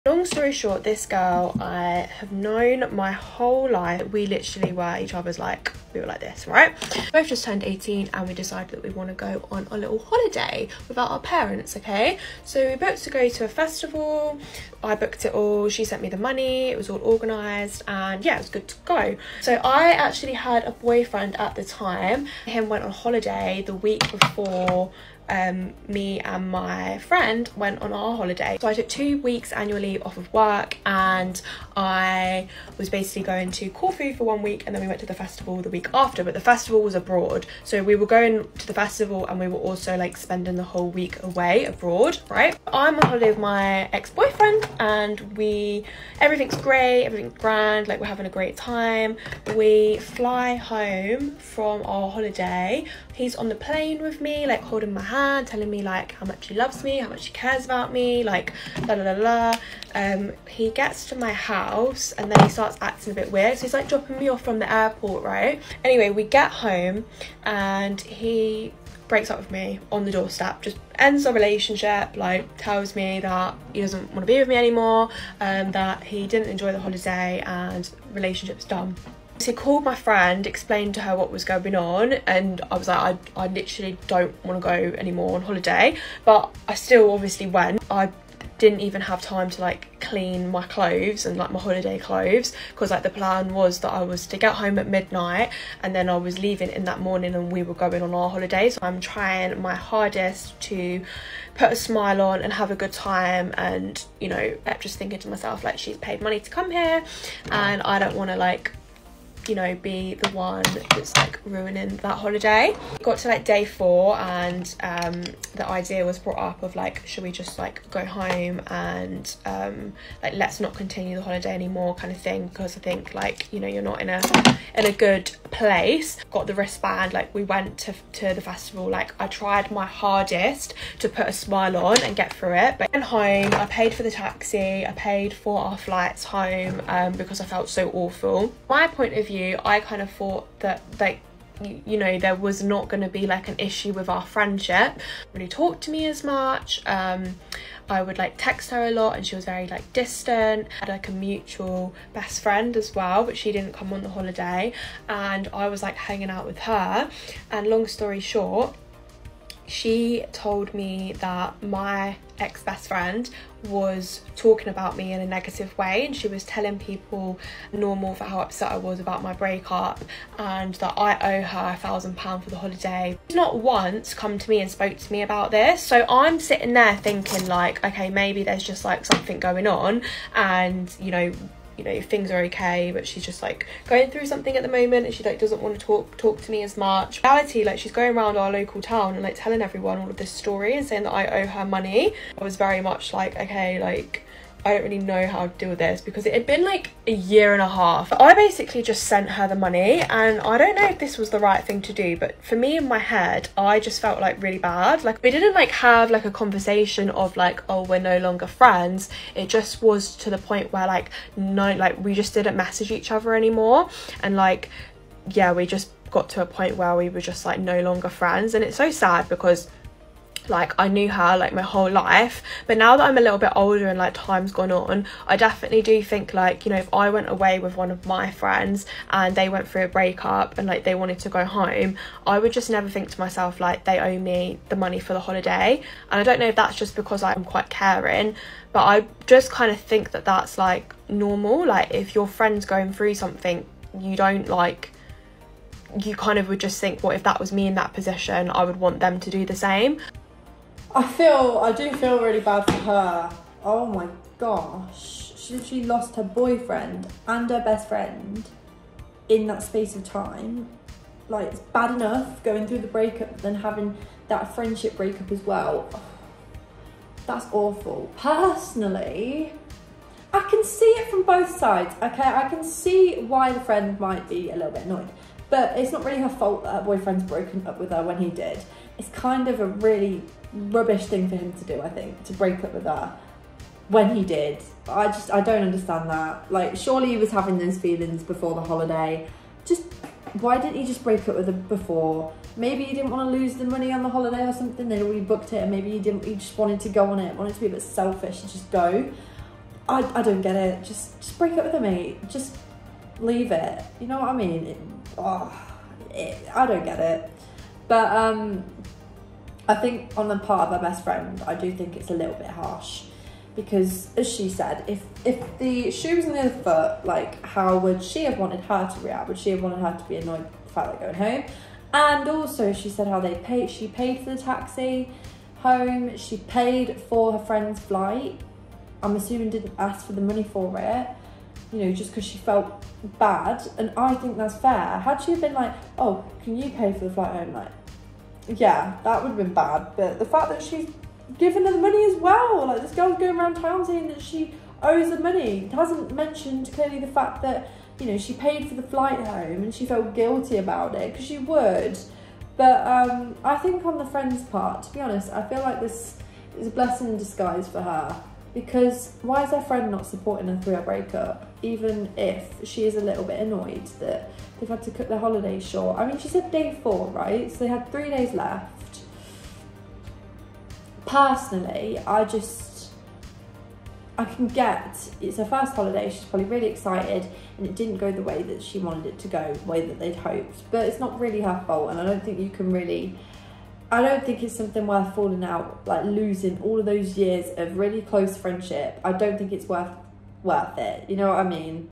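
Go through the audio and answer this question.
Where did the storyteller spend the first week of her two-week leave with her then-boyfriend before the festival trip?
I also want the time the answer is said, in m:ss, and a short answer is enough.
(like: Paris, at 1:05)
Corfu, at 0:33.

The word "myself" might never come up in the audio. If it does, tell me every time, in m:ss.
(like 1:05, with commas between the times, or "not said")
1:45, 3:53.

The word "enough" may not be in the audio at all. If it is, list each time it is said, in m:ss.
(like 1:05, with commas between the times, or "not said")
4:21.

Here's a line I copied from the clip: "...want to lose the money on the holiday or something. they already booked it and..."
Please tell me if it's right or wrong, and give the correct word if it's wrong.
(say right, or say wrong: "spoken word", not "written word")
right.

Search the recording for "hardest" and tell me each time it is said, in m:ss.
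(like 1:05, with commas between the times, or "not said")
1:39, 2:09.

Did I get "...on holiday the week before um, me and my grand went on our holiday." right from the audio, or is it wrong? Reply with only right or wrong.
wrong.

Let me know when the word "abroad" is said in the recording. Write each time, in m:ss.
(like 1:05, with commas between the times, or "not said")
0:36, 0:41.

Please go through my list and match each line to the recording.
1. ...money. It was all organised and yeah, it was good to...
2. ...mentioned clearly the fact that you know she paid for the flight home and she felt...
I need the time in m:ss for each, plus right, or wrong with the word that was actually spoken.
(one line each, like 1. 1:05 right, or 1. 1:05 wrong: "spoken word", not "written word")
1. 0:16 right
2. 5:46 right.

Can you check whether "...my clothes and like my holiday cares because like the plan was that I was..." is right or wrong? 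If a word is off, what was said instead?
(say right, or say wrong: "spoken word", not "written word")
wrong: "clothes", not "cares".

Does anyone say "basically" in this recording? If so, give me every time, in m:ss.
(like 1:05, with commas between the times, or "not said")
0:32, 3:18.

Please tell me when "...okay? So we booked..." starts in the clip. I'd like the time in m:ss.
0:11.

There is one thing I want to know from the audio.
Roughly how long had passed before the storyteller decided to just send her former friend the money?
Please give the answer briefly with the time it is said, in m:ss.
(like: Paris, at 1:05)
a year and a half, at 3:17.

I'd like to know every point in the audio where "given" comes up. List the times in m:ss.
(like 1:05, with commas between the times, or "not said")
5:41.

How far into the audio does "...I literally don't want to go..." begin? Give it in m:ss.
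1:23.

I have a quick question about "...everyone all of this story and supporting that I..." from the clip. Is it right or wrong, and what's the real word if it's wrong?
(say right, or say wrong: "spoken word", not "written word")
wrong: "saying", not "supporting".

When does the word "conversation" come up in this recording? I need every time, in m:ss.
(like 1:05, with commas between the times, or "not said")
3:26.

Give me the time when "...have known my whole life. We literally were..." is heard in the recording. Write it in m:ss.
0:02.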